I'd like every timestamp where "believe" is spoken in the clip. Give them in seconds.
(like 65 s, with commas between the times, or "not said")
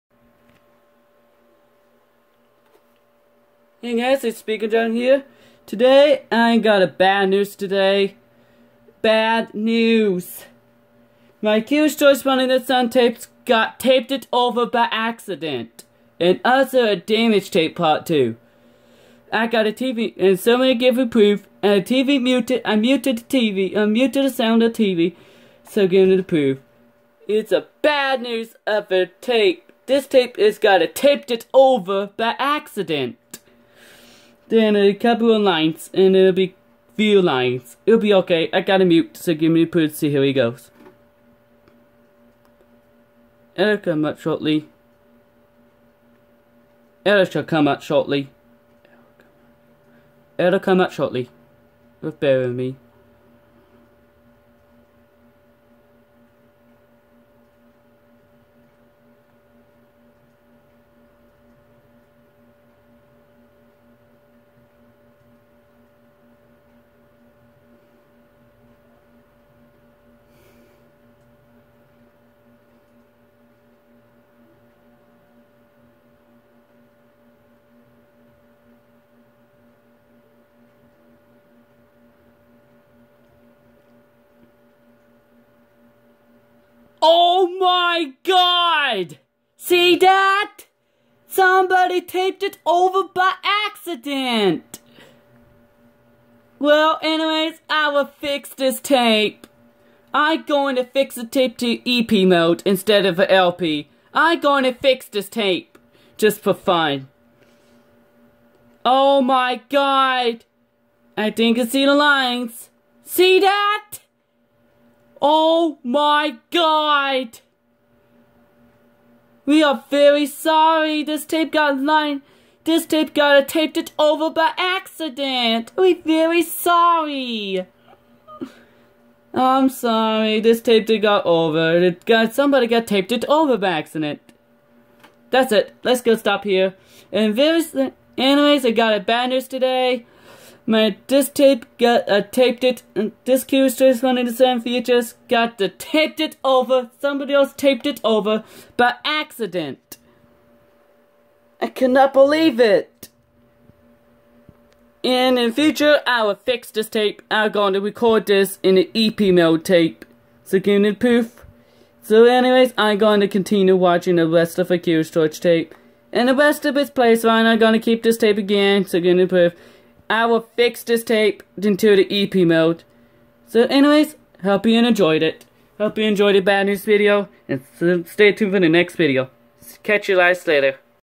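152 s.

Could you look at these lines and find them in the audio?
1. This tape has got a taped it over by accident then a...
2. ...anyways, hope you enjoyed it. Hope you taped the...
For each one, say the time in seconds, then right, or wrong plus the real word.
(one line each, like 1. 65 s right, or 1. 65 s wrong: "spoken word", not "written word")
1. 29 s right
2. 173 s wrong: "enjoyed", not "taped".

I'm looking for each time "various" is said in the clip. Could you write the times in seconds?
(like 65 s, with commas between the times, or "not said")
137 s.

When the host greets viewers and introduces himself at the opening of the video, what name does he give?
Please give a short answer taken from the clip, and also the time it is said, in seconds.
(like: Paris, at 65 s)
John, at 4 s.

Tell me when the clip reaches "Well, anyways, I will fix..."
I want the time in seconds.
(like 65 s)
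96 s.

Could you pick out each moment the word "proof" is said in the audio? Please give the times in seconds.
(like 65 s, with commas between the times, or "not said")
21 s, 26 s.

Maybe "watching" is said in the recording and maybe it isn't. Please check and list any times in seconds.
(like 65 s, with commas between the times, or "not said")
163 s.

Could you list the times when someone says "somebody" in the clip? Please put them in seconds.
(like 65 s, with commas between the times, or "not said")
20 s, 91 s, 132 s, 146 s.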